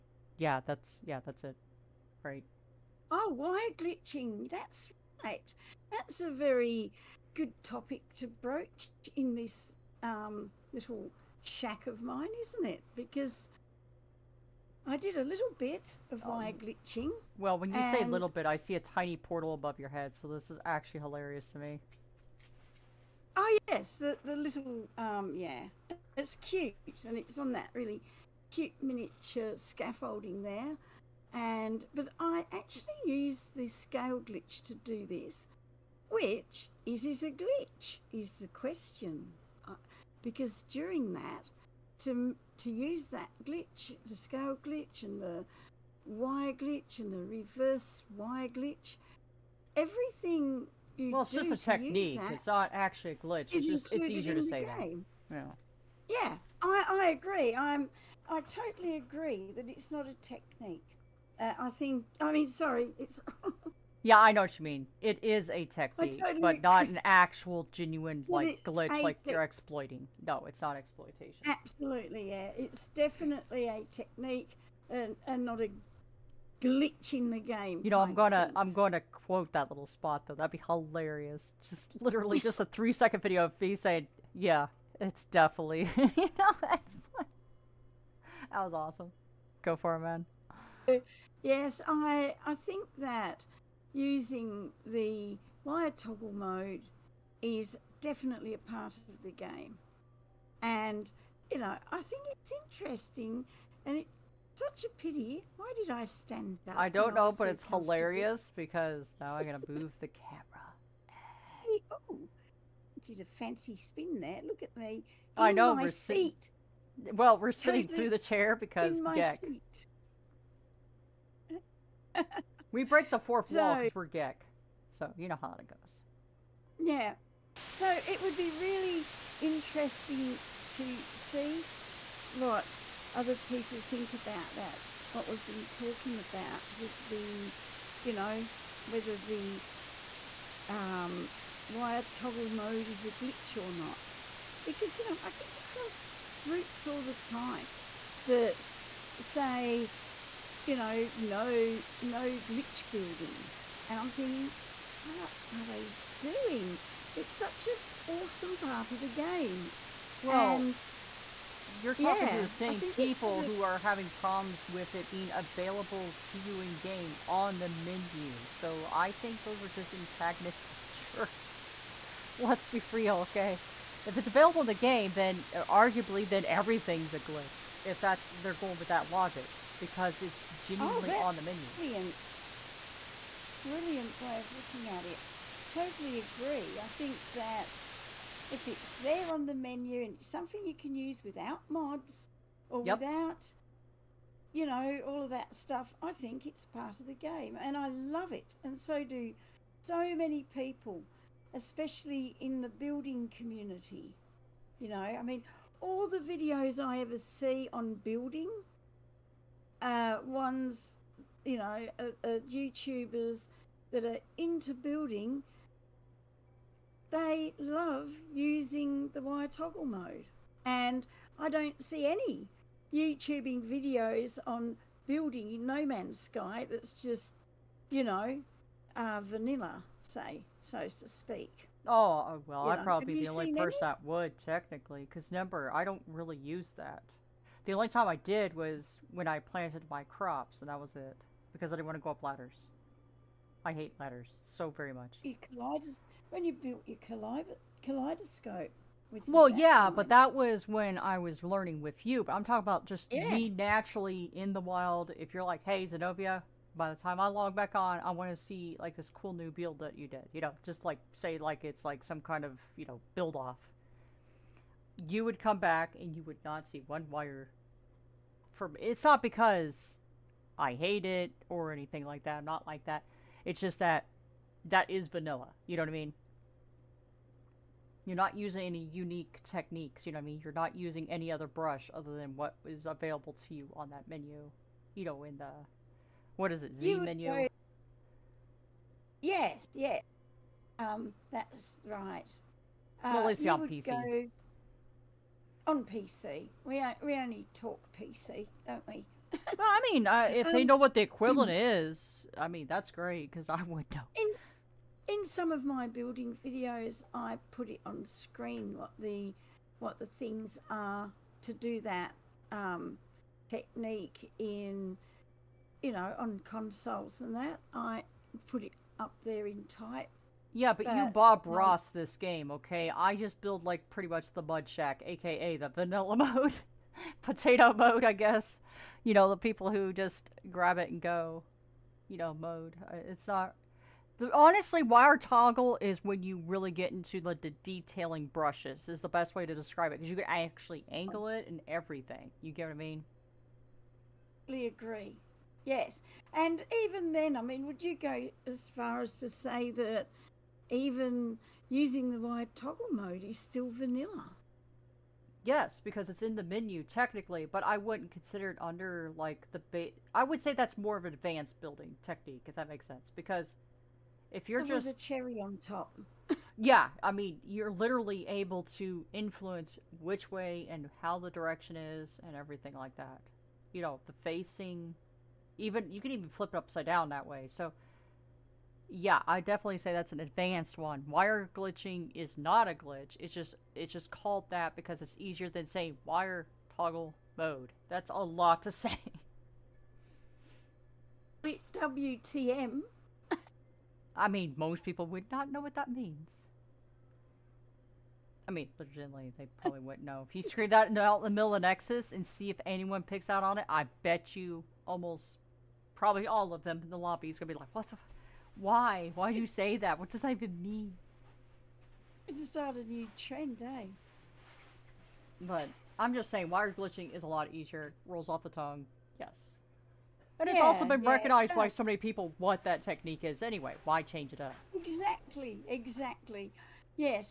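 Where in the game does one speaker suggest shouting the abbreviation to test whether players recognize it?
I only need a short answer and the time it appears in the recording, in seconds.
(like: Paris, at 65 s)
Nexus, at 401 s.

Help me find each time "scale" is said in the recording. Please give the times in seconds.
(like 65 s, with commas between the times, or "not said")
33 s, 44 s.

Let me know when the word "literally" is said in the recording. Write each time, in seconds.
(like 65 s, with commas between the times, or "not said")
82 s, 367 s.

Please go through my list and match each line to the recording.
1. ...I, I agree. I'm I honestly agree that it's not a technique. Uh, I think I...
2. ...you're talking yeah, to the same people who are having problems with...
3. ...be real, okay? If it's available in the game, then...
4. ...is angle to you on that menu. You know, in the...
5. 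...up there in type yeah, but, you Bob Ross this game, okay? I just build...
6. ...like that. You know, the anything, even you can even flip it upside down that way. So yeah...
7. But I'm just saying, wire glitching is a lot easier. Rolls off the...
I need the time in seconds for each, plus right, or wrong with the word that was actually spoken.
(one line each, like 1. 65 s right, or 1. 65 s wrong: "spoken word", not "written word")
1. 56 s wrong: "totally", not "honestly"
2. 161 s right
3. 172 s right
4. 282 s wrong: "available", not "angle"
5. 318 s right
6. 372 s wrong: "facing", not "anything"
7. 415 s right.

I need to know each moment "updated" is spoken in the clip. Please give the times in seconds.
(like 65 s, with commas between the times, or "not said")
not said.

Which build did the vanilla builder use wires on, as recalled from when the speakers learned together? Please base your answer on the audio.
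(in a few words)
kaleidoscope.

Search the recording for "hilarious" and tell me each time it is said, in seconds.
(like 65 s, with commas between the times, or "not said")
21 s, 80 s, 107 s.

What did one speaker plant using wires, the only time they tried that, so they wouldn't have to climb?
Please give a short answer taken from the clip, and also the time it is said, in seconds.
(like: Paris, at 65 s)
crops, at 240 s.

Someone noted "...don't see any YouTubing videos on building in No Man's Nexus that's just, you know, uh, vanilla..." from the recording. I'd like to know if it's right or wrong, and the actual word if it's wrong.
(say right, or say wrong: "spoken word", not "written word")
wrong: "Sky", not "Nexus".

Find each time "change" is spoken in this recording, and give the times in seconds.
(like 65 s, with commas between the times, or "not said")
424 s.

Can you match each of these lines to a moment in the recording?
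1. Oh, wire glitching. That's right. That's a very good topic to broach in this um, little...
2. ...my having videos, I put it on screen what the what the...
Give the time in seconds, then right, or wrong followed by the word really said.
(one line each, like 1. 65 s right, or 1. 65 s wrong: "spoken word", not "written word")
1. 3 s right
2. 305 s wrong: "building", not "having".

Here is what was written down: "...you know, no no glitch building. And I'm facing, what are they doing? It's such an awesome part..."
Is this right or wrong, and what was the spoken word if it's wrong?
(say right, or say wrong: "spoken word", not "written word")
wrong: "thinking", not "facing".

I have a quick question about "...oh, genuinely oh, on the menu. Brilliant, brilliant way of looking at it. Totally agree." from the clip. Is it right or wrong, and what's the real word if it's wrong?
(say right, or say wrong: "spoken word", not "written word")
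right.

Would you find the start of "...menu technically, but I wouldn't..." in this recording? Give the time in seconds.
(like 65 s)
356 s.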